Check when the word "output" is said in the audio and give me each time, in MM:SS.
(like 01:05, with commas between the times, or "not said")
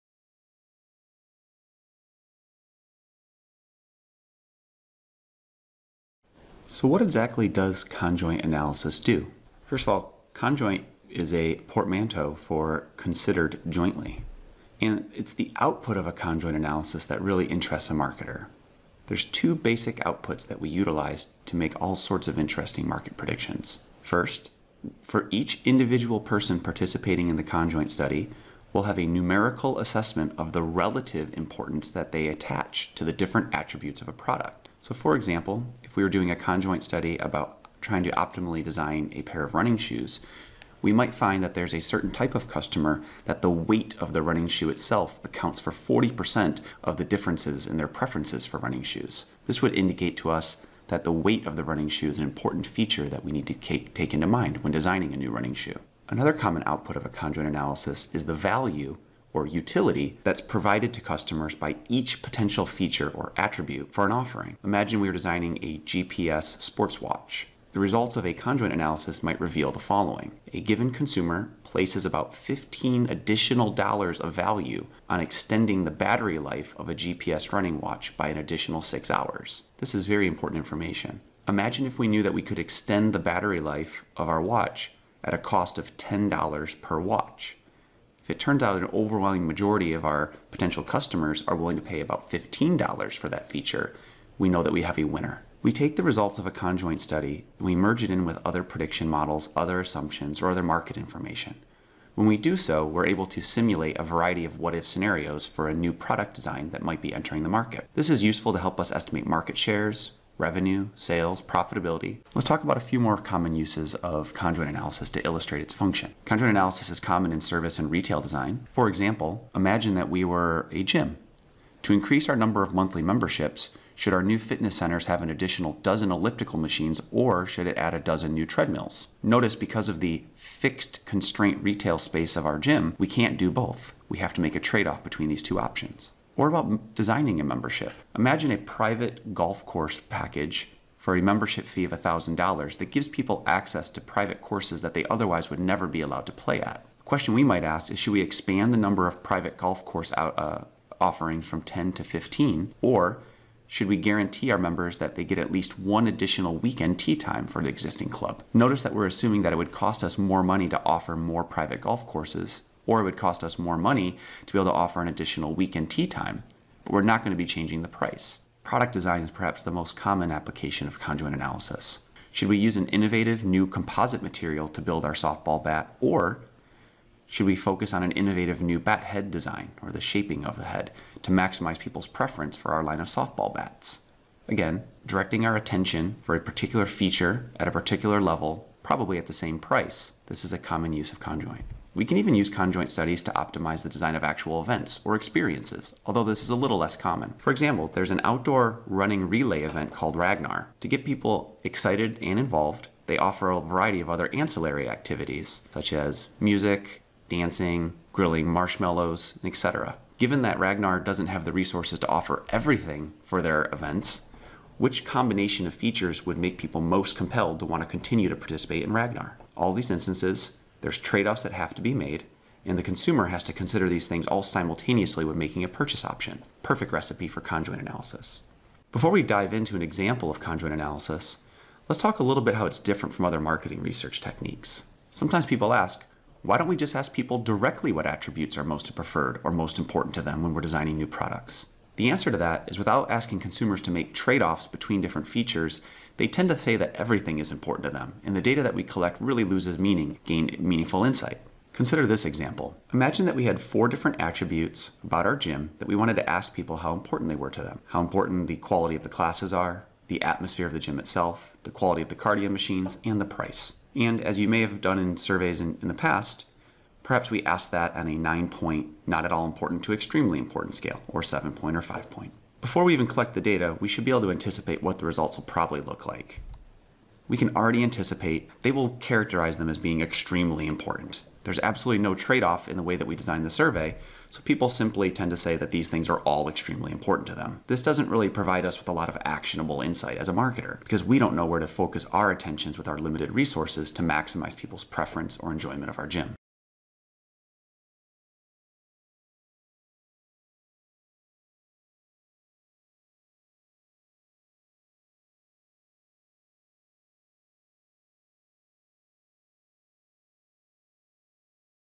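00:15, 00:20, 00:56.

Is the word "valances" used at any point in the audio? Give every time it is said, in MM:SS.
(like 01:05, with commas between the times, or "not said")
not said.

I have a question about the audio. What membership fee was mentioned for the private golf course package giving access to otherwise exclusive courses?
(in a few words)
$1,000.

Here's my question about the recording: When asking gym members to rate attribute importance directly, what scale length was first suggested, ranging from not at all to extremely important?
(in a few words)
9 point.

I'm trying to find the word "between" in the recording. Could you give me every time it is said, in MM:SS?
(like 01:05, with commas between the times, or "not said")
02:15, 04:04.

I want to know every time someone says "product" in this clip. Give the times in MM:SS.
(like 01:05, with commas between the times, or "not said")
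00:34, 01:45, 02:48, 04:01.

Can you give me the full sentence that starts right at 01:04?
Imagine we were designing a GPS sports watch.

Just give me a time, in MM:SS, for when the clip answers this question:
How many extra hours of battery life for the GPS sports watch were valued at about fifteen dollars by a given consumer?
01:18.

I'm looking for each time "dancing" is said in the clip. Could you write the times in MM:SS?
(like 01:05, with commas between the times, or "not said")
03:27.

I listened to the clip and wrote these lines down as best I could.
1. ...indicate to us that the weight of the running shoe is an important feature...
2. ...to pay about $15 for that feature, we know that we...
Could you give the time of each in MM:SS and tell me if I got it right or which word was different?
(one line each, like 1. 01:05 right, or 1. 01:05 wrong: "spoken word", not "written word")
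1. 00:49 right
2. 01:31 right.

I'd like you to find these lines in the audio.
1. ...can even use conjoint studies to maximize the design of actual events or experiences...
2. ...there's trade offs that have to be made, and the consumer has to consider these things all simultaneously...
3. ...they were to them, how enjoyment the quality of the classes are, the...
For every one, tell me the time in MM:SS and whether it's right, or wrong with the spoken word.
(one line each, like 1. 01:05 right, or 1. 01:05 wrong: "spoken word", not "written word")
1. 03:12 wrong: "optimize", not "maximize"
2. 03:40 right
3. 04:17 wrong: "important", not "enjoyment".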